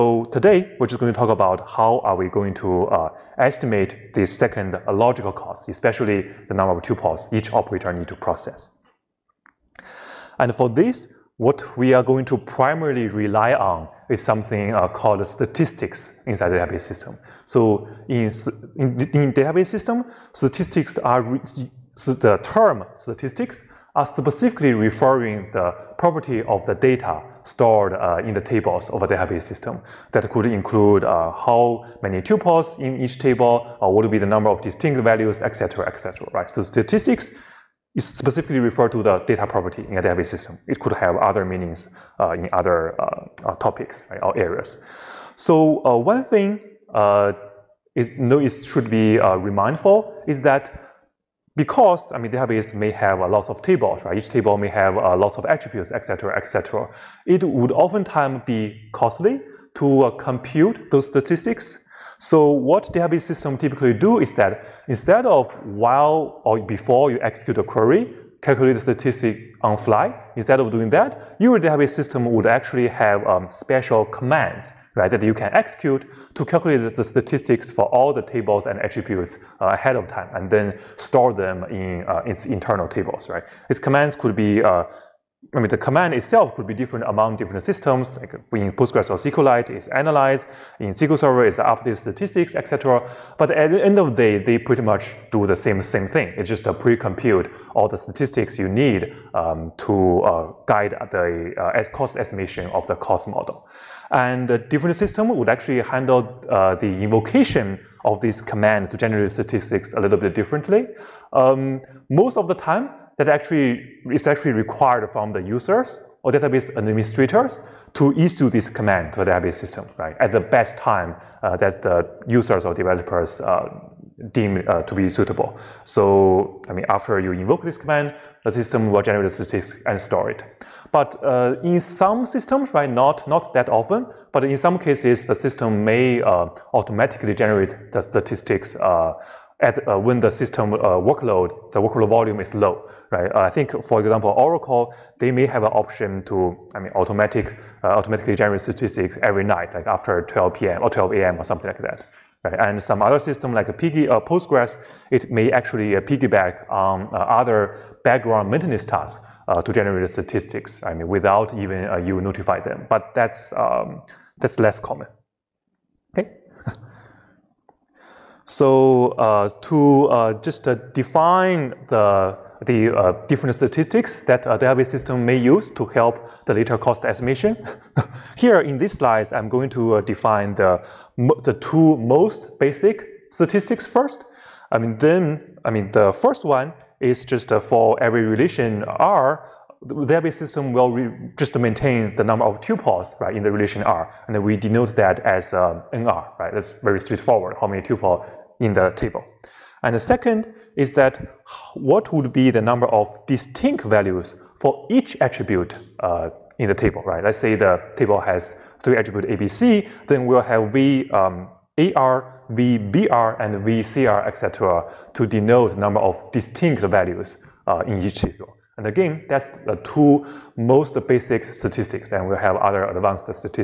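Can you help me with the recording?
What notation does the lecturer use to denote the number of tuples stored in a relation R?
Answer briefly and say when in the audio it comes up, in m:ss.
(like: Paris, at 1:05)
NR, at 3:15.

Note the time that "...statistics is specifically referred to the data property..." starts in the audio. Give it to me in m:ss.
0:36.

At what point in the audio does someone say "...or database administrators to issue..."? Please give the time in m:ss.
1:56.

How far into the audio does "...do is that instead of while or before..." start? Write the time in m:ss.
1:03.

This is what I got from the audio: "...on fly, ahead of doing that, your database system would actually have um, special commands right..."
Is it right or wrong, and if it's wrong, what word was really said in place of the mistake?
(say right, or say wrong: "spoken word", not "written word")
wrong: "instead", not "ahead".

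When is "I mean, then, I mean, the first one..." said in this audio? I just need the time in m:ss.
3:04.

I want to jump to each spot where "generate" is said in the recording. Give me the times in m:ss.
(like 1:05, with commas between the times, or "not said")
1:48, 2:09, 2:17, 2:28, 2:39.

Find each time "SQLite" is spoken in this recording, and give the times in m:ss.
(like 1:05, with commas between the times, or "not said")
1:29.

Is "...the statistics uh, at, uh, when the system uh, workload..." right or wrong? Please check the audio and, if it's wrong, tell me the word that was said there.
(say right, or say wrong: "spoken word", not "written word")
right.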